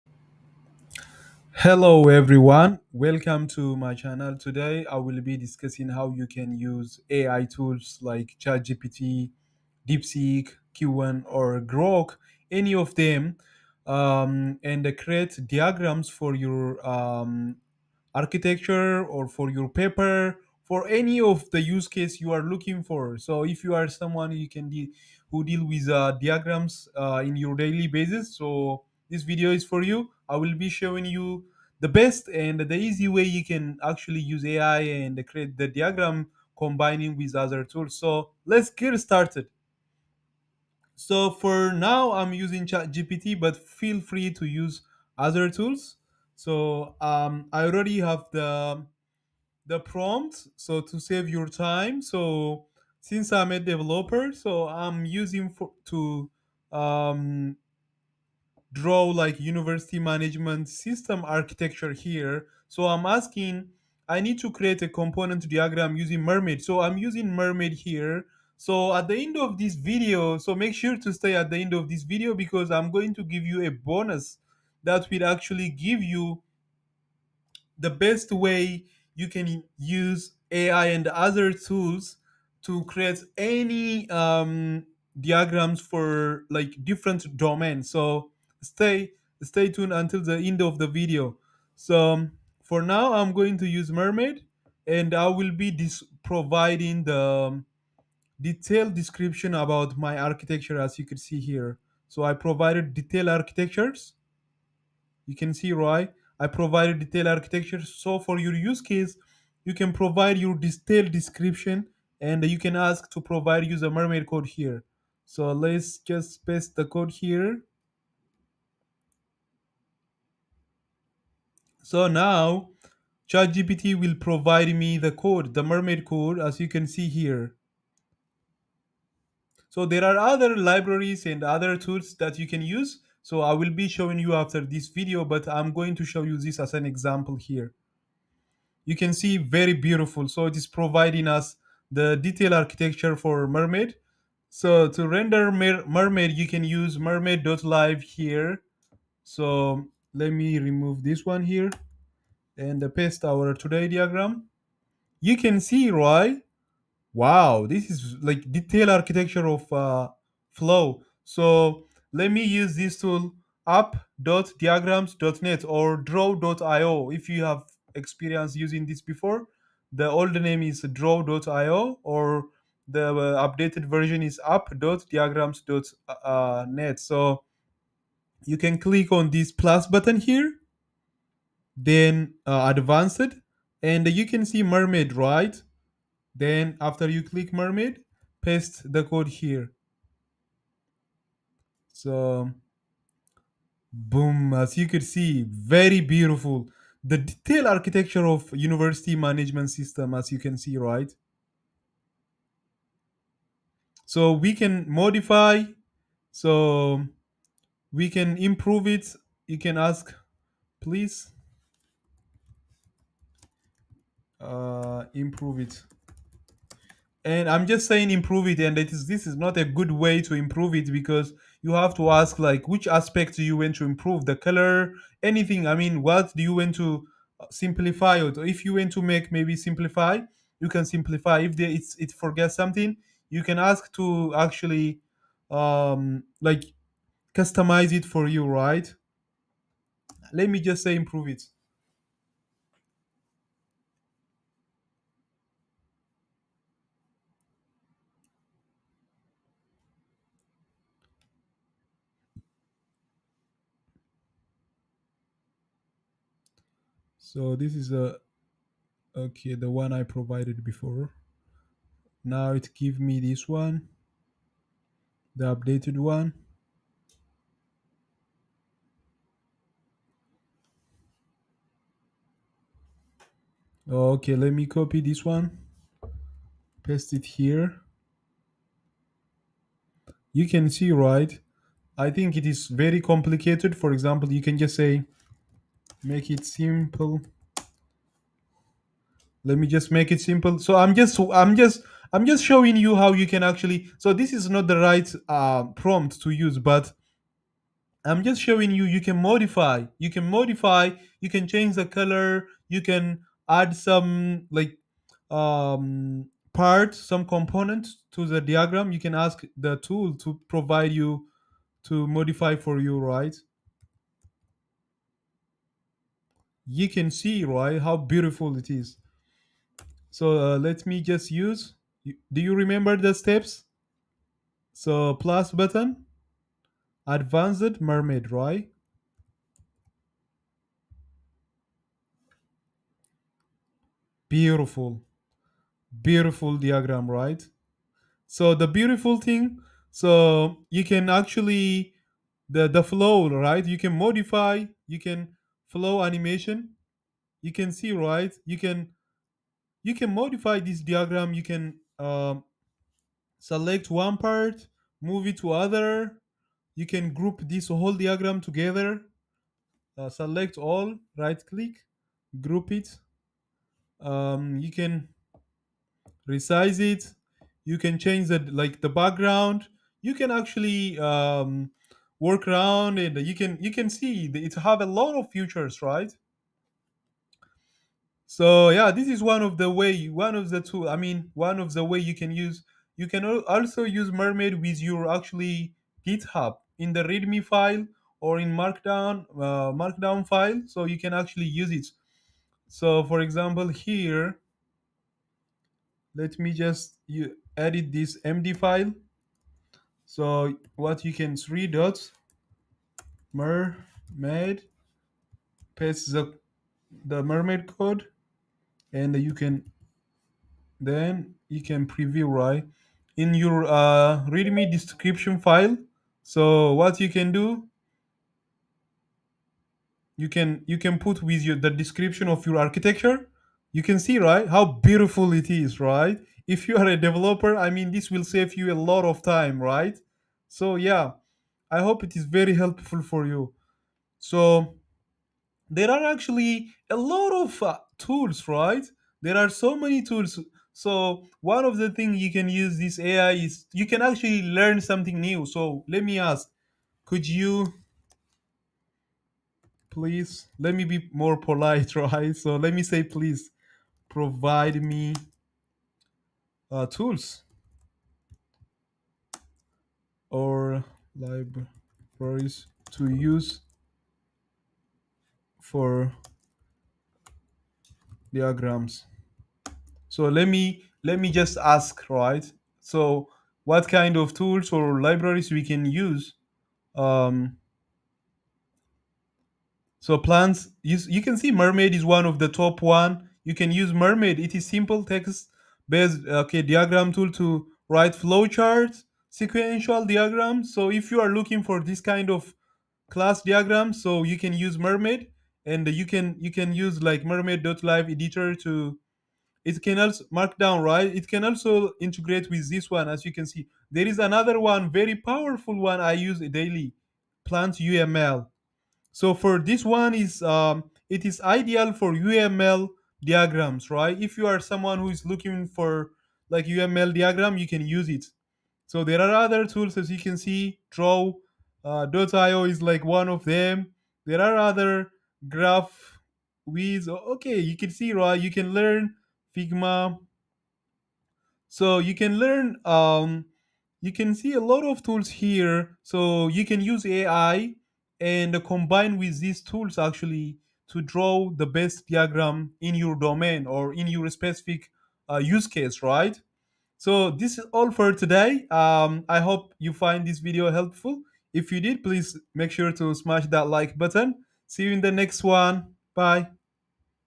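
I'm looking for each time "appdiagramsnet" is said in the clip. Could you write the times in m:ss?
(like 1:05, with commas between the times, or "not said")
2:43, 2:54.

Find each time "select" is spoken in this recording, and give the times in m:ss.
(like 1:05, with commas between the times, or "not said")
5:53, 6:00.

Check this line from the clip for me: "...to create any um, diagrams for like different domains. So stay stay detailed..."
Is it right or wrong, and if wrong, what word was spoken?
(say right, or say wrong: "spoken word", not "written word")
wrong: "tuned", not "detailed".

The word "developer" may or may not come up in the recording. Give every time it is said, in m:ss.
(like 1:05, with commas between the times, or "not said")
0:53, 7:07.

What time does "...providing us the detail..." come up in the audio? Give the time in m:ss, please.
2:20.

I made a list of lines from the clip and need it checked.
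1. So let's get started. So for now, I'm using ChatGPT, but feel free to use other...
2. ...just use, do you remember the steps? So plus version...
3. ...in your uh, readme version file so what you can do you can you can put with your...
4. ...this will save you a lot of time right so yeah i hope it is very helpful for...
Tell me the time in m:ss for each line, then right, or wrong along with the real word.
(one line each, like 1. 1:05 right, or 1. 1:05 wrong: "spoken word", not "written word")
1. 0:37 right
2. 5:21 wrong: "button", not "version"
3. 6:53 wrong: "description", not "version"
4. 7:07 right.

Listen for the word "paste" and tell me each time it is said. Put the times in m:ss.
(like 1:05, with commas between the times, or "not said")
1:56, 2:32, 3:08, 4:36, 6:45.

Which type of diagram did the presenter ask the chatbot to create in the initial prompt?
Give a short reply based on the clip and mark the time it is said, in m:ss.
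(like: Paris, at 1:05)
Component diagram, at 1:04.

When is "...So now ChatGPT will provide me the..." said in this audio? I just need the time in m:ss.
2:01.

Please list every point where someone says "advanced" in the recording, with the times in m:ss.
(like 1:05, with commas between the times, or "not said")
3:02, 5:27.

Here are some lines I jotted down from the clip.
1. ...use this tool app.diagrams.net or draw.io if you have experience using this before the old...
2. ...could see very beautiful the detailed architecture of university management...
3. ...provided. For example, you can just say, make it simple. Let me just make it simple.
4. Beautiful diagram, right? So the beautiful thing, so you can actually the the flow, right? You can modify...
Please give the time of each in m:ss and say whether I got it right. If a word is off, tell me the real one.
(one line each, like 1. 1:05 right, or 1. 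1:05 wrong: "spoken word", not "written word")
1. 2:42 right
2. 3:14 right
3. 4:43 wrong: "complicated", not "provided"
4. 5:36 right.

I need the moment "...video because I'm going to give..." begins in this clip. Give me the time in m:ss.
1:12.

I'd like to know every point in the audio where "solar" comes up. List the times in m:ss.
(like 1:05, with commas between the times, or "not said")
not said.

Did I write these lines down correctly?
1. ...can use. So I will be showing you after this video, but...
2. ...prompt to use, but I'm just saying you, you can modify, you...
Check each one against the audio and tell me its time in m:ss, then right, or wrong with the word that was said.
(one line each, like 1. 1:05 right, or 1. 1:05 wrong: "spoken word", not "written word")
1. 2:12 right
2. 4:55 wrong: "showing", not "saying".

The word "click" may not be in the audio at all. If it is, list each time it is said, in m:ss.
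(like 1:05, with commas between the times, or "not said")
2:58, 3:07, 6:01.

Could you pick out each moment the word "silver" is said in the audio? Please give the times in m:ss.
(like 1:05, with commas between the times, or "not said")
not said.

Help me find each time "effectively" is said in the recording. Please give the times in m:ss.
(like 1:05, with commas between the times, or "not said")
not said.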